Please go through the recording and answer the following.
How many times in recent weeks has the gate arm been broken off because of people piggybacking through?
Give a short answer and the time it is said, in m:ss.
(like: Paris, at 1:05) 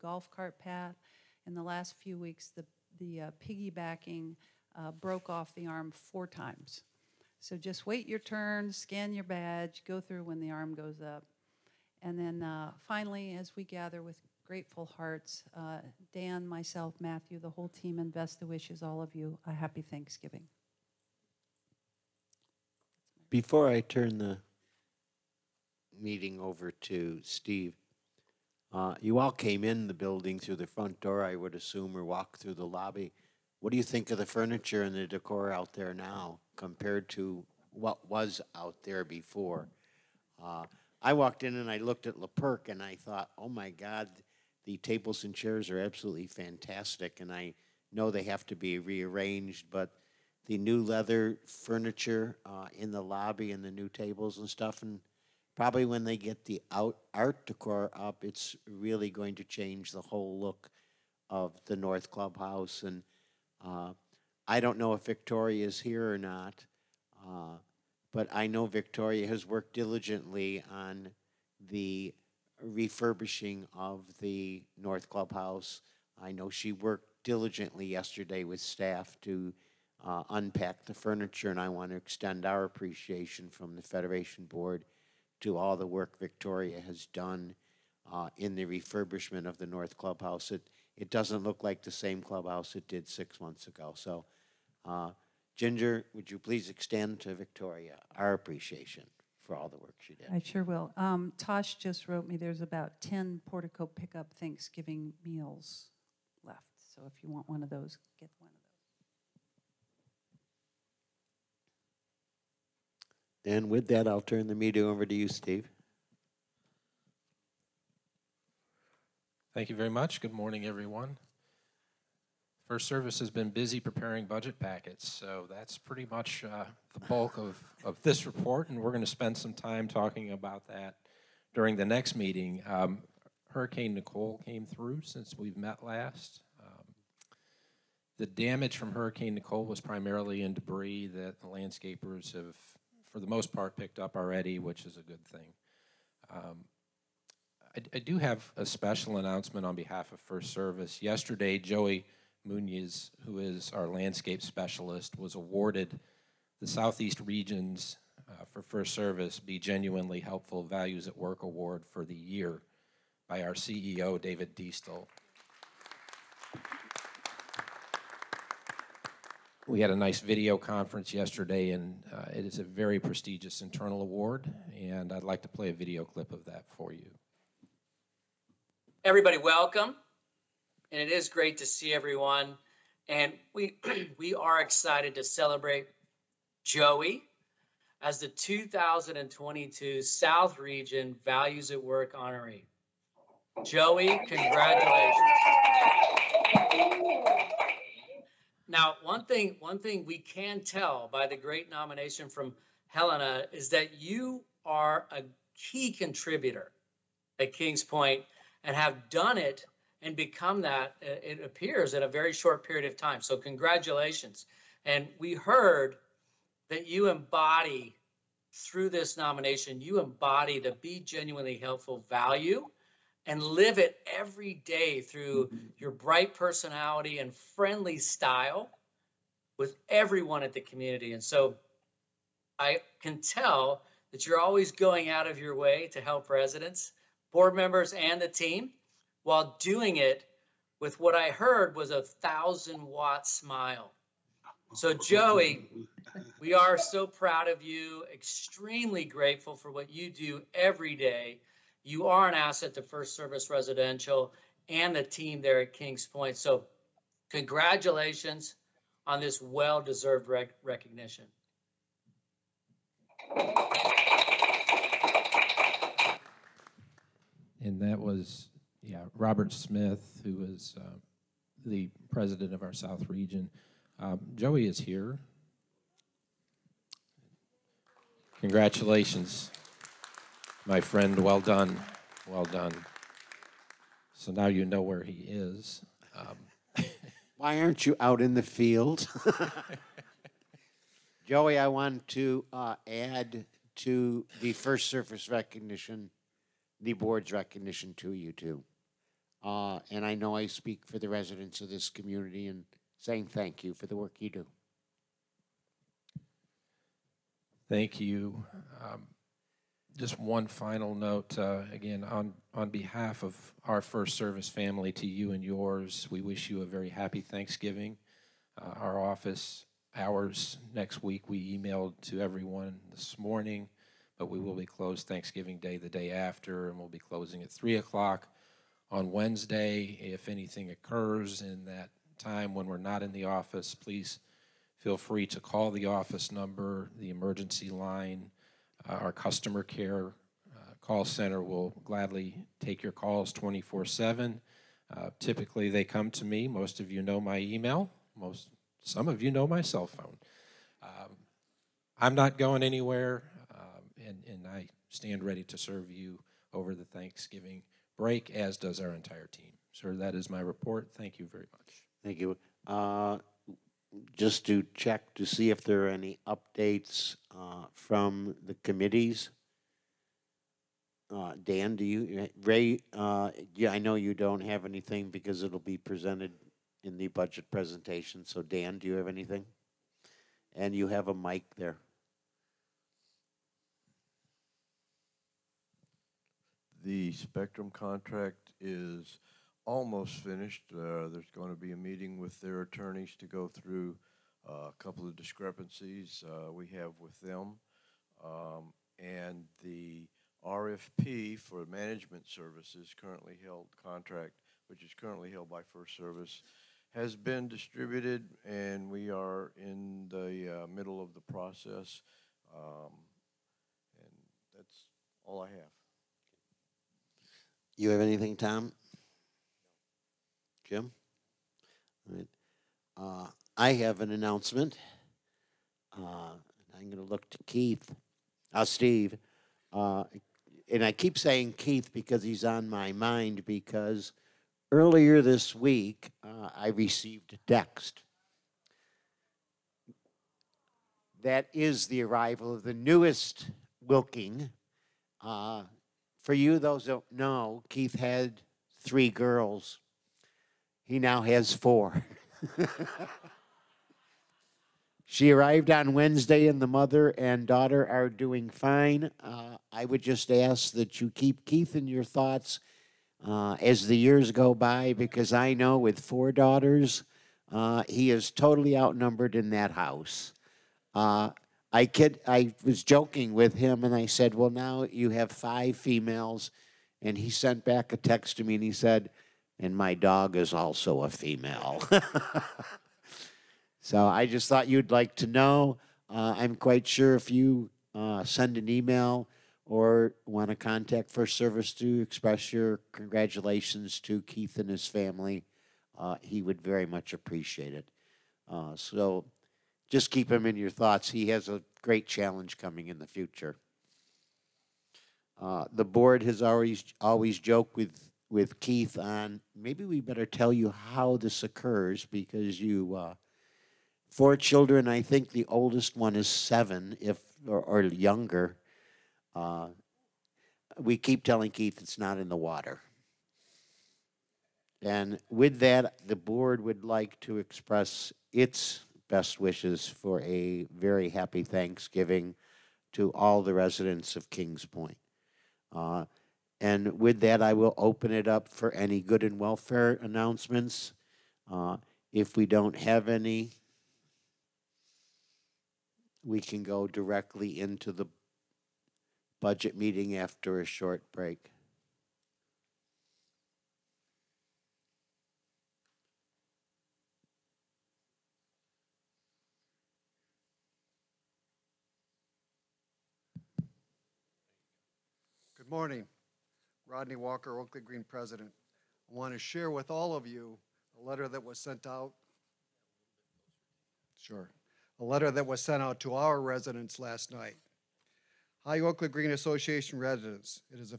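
4, at 0:06.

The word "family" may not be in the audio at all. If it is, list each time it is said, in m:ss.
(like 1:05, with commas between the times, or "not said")
5:14, 8:14.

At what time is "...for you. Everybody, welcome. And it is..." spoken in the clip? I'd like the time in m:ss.
2:56.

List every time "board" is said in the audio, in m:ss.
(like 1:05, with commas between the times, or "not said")
1:24, 3:57, 4:56, 8:25, 8:46.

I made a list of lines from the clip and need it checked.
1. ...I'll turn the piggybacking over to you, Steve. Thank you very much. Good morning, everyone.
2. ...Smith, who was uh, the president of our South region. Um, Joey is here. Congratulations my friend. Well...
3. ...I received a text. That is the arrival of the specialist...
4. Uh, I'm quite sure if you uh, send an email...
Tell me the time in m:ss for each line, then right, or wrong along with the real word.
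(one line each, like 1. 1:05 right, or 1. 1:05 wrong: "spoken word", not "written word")
1. 1:54 wrong: "meeting", not "piggybacking"
2. 4:29 right
3. 7:16 wrong: "newest", not "specialist"
4. 8:06 right.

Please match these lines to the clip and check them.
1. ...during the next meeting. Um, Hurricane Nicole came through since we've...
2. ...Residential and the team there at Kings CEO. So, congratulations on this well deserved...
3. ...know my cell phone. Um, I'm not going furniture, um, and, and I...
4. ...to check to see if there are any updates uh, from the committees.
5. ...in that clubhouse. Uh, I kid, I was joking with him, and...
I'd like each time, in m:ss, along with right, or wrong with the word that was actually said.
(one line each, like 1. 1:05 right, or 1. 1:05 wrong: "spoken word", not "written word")
1. 2:11 right
2. 4:13 wrong: "Point", not "CEO"
3. 5:49 wrong: "anywhere", not "furniture"
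4. 6:04 right
5. 7:49 wrong: "house", not "clubhouse".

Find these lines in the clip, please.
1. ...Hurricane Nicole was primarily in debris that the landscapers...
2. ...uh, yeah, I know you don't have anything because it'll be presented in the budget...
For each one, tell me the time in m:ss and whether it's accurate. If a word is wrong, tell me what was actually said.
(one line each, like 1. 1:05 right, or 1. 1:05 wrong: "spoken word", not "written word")
1. 2:18 right
2. 6:12 right.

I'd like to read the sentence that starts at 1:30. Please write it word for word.
It, it doesn't look like the same clubhouse it did six months ago.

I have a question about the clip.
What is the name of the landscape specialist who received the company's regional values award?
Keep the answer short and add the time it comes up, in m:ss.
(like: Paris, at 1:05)
Joey Munoz, at 2:31.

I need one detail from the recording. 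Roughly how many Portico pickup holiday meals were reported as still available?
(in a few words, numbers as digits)
10.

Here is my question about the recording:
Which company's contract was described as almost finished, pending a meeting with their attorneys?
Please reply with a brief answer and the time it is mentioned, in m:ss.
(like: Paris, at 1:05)
Spectrum, at 6:27.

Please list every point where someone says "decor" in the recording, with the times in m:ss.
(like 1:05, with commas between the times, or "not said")
0:35, 0:57.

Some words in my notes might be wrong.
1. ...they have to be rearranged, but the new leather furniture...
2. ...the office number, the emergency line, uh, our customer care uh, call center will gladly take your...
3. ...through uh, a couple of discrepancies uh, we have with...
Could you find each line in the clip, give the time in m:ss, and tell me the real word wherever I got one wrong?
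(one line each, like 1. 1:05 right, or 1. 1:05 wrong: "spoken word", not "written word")
1. 0:48 right
2. 5:35 right
3. 6:33 right.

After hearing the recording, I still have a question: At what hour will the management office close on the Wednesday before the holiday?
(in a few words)
3 o'clock.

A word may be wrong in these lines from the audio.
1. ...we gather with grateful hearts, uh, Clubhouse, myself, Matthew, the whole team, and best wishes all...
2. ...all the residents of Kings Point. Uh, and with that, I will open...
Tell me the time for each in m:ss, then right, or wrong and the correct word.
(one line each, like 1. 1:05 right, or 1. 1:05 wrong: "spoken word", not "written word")
1. 0:13 wrong: "Dan", not "Clubhouse"
2. 8:53 right.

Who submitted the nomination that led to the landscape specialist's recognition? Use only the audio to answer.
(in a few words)
Helena.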